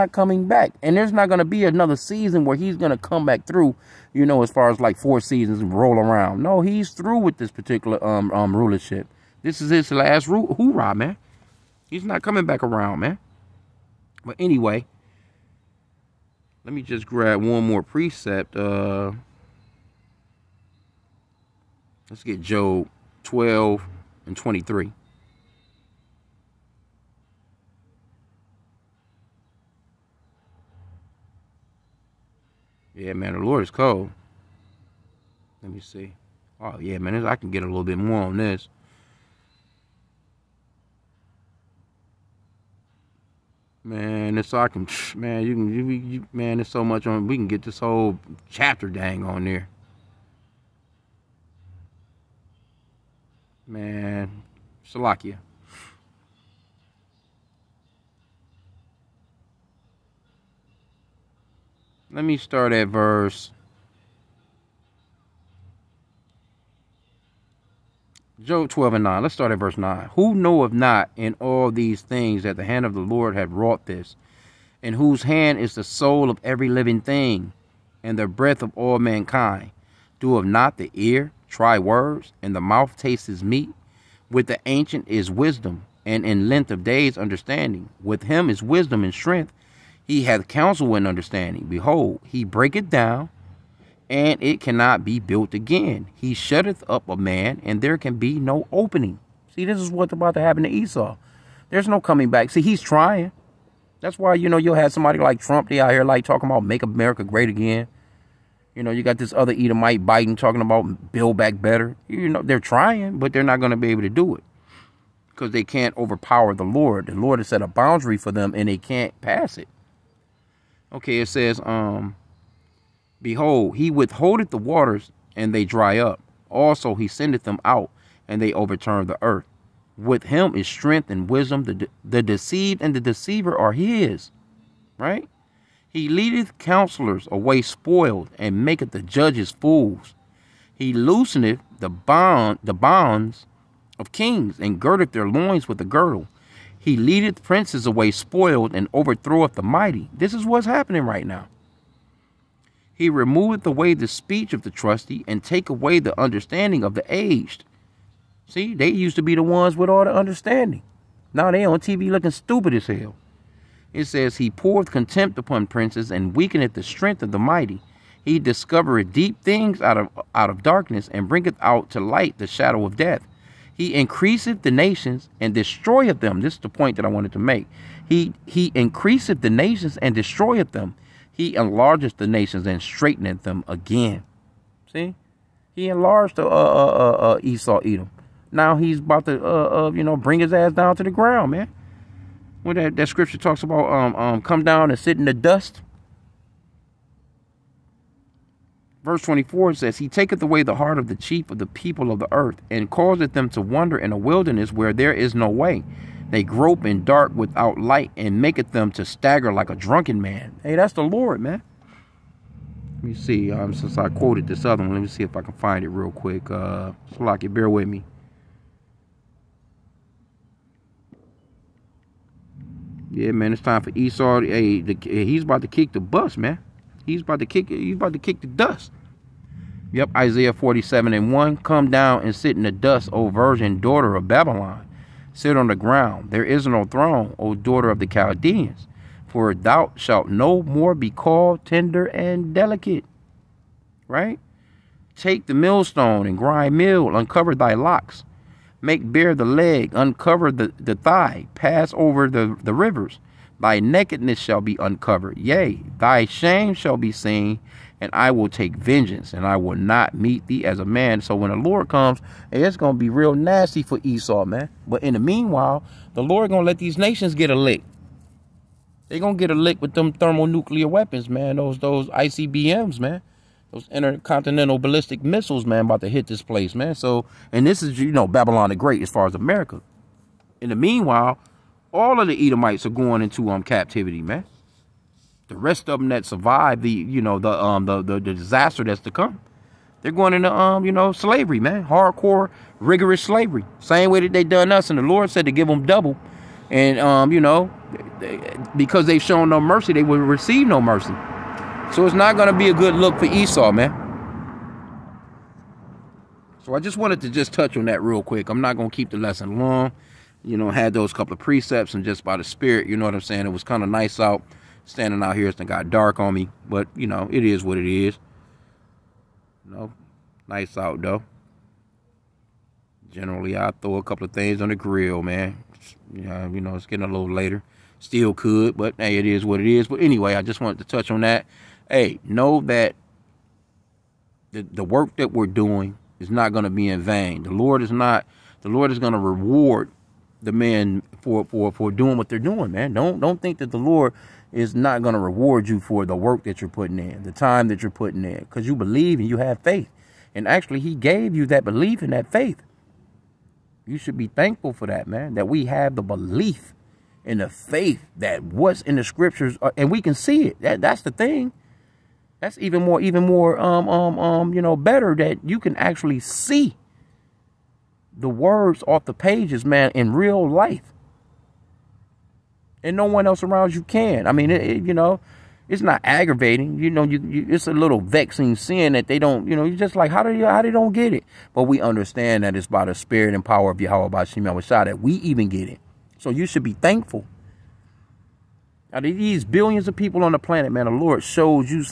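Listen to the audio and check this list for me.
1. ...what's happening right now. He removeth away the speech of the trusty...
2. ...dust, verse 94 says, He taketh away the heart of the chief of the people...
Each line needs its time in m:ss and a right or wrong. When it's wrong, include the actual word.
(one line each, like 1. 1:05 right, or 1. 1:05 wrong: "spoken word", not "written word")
1. 2:30 right
2. 3:15 wrong: "24", not "94".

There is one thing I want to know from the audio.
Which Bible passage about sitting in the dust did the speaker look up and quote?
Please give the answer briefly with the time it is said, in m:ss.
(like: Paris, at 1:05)
Isaiah 47:1, at 3:50.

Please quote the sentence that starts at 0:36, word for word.
Oh, yeah, man, I can get a little bit more on this.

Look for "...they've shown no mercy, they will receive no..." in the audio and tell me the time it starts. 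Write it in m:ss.
4:59.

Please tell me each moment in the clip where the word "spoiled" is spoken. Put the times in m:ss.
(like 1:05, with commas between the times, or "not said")
2:17, 2:28.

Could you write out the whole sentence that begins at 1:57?
The Lord has set a boundary for them and they can't pass it.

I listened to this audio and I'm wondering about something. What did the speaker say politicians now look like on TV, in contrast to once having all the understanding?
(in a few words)
stupid.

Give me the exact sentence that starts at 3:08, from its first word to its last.
Now he's about to uh, uh, you know bring his ass down to the ground, man.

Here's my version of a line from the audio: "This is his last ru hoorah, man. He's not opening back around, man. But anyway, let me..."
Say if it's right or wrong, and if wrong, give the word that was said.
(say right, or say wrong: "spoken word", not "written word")
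wrong: "coming", not "opening".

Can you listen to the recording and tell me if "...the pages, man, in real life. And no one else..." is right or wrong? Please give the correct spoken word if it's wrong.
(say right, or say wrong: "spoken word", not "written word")
right.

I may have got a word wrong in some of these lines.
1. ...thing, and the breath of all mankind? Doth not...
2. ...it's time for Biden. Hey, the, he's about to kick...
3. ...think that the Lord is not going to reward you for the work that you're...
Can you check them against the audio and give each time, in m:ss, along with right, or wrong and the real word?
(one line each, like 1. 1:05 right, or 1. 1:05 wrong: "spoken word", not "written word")
1. 1:17 right
2. 3:43 wrong: "Esau", not "Biden"
3. 5:43 right.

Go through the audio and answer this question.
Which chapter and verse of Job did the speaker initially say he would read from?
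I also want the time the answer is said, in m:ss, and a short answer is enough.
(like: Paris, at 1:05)
Job 12:23, at 0:22.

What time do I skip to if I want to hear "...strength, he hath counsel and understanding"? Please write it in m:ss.
1:29.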